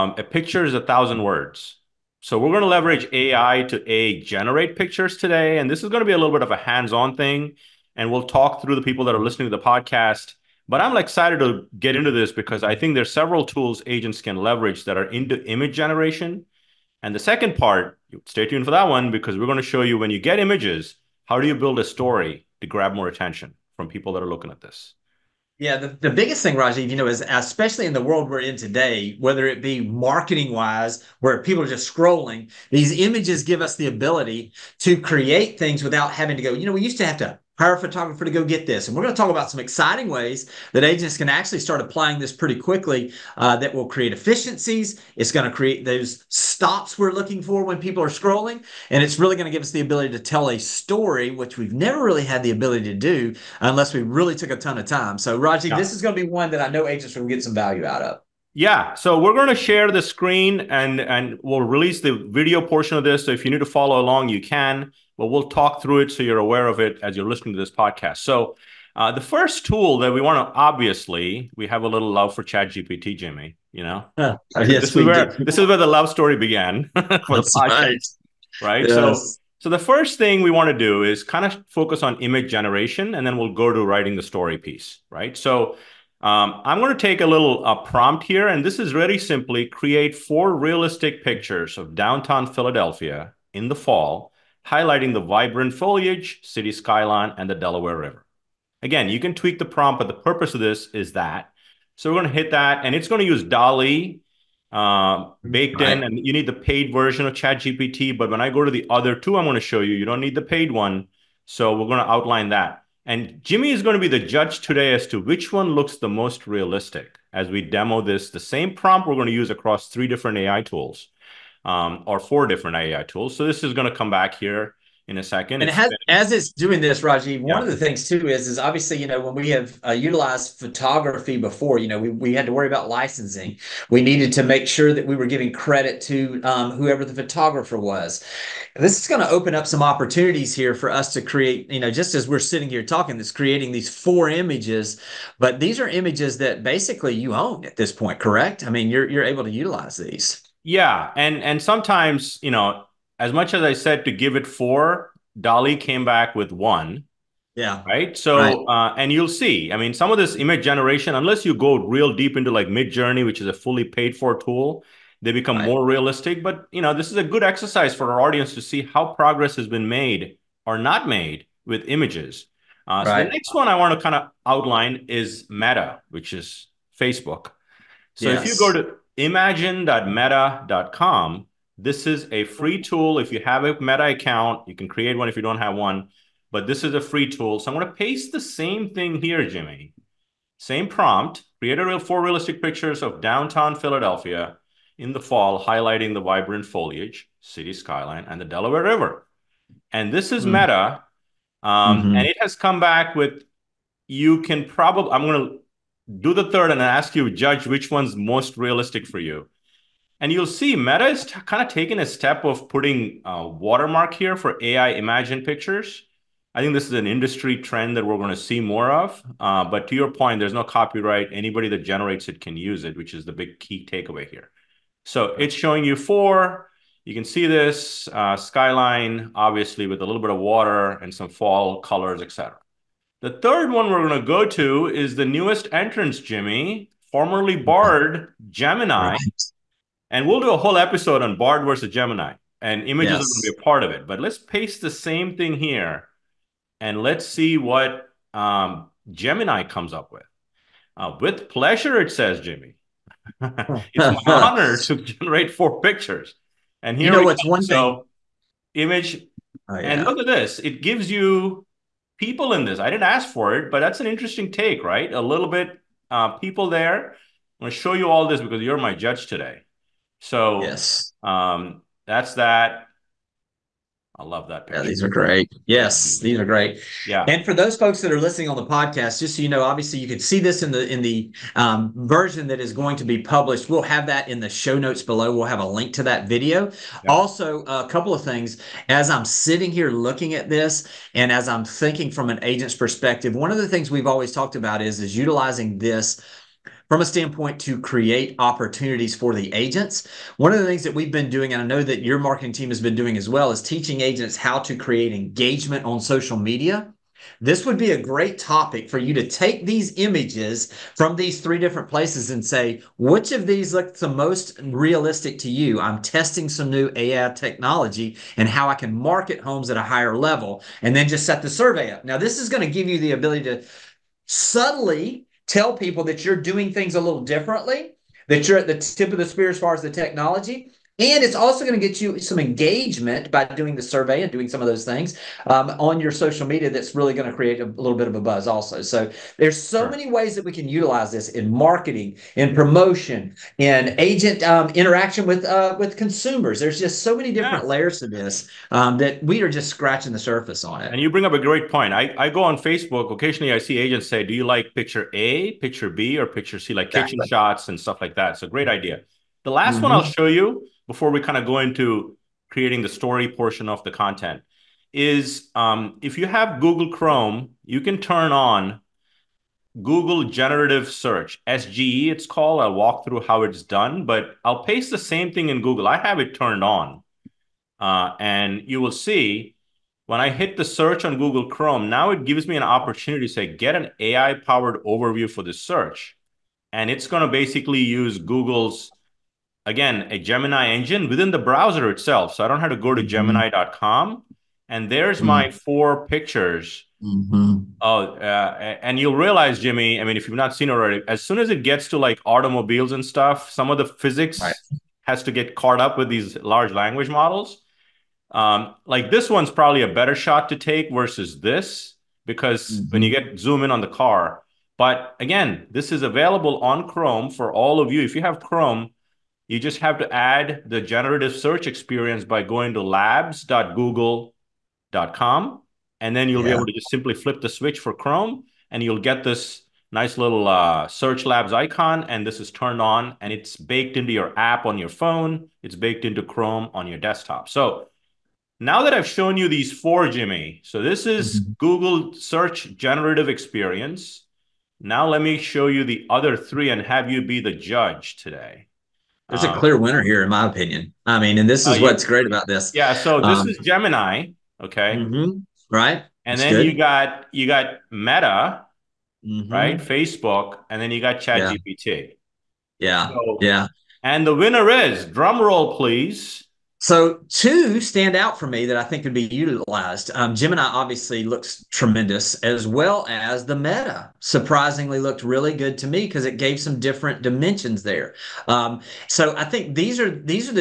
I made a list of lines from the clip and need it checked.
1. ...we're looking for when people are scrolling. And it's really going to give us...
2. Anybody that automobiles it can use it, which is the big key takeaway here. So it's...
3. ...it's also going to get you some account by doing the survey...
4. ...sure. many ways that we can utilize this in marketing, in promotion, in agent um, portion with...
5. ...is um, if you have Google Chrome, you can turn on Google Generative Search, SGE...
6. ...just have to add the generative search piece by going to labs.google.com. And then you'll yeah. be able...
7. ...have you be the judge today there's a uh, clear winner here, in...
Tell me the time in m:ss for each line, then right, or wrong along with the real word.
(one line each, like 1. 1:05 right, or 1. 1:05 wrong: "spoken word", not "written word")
1. 0:46 right
2. 3:41 wrong: "generates", not "automobiles"
3. 5:31 wrong: "engagement", not "account"
4. 5:39 wrong: "interaction", not "portion"
5. 6:04 right
6. 6:59 wrong: "experience", not "piece"
7. 7:26 right.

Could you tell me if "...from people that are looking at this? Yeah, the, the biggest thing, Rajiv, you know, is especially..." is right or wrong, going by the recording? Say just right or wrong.
right.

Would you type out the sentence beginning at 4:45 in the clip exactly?
We'll have a link to that video.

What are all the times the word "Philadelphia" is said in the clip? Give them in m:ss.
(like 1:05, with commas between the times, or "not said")
1:32, 3:13.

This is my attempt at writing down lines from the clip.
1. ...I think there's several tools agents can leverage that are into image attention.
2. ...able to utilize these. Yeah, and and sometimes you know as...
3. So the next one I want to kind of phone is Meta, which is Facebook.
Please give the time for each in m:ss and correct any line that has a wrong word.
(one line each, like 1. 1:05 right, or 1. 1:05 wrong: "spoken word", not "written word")
1. 0:12 wrong: "generation", not "attention"
2. 2:29 right
3. 2:53 wrong: "outline", not "phone".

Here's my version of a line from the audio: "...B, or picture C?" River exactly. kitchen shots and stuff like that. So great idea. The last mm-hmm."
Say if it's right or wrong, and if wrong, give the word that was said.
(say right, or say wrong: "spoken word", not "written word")
wrong: "Like", not "River".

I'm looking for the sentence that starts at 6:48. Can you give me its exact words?
Um, like this one's probably a better shot to take versus this because mm-hmm.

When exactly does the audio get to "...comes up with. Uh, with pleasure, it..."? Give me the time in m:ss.
4:09.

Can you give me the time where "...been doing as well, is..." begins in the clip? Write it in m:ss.
5:02.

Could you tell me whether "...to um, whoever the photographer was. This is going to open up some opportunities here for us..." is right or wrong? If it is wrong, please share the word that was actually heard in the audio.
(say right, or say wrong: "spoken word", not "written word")
right.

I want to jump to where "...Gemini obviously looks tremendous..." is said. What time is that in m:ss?
7:50.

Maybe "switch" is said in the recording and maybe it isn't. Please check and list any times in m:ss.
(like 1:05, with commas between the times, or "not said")
7:07.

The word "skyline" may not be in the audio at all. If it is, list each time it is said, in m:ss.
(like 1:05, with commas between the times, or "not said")
1:36, 3:17, 3:48.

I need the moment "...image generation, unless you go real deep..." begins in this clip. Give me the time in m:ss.
2:40.